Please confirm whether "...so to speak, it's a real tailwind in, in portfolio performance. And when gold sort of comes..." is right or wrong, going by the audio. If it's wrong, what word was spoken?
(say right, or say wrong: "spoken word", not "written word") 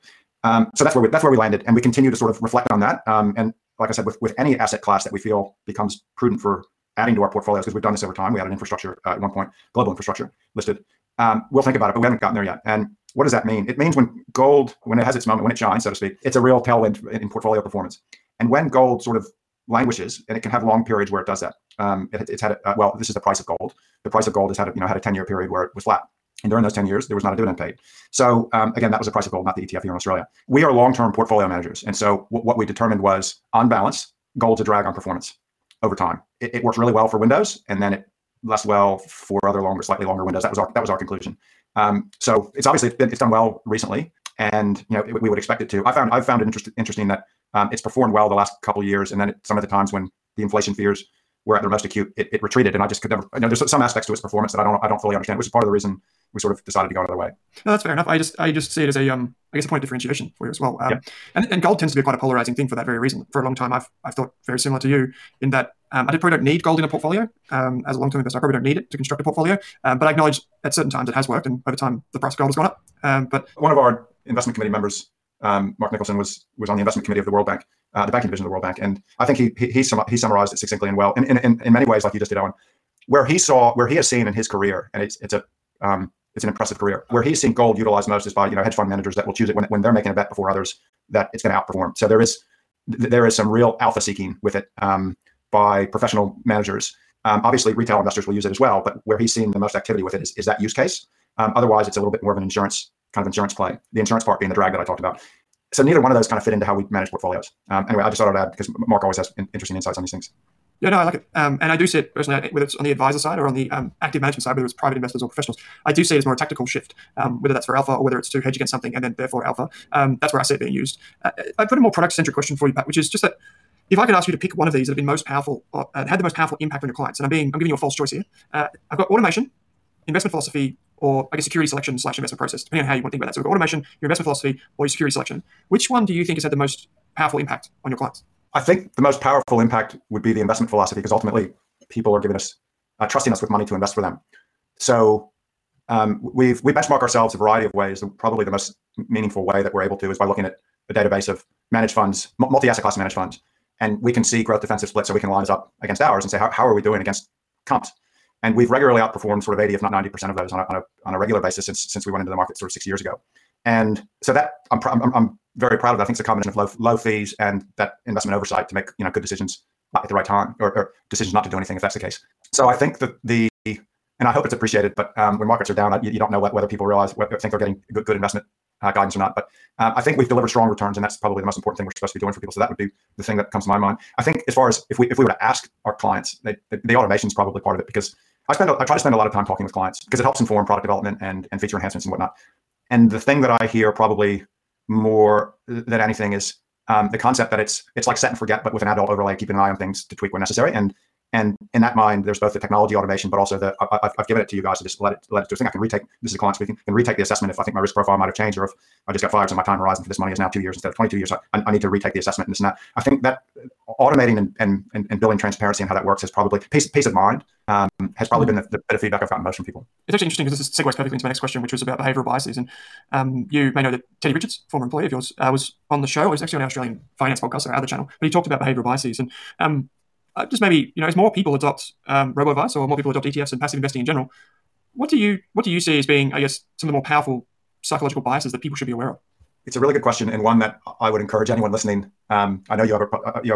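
wrong: "languishes", not "comes".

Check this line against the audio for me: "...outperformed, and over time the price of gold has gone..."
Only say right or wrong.
wrong.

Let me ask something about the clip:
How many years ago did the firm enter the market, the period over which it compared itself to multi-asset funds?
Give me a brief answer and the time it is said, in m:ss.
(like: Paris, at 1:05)
6 years, at 2:42.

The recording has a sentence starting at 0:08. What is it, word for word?
We added infrastructure uh, at one point, global infrastructure listed.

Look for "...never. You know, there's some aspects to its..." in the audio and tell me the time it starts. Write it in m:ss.
0:53.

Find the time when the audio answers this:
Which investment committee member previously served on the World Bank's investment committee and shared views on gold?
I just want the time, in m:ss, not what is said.
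1:15.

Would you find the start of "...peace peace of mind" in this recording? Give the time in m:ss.
3:36.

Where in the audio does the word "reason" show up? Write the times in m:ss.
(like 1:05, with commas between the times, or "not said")
0:55, 1:02.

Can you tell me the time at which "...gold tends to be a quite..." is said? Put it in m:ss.
1:01.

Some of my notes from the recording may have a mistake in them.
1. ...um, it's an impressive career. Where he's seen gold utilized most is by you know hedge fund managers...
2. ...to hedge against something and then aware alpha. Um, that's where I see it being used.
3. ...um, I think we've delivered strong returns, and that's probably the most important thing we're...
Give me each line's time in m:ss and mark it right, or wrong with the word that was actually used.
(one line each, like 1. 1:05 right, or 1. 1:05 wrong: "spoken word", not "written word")
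1. 1:25 right
2. 1:58 wrong: "therefore", not "aware"
3. 2:59 right.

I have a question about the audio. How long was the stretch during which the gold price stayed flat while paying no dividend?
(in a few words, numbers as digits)
10 years.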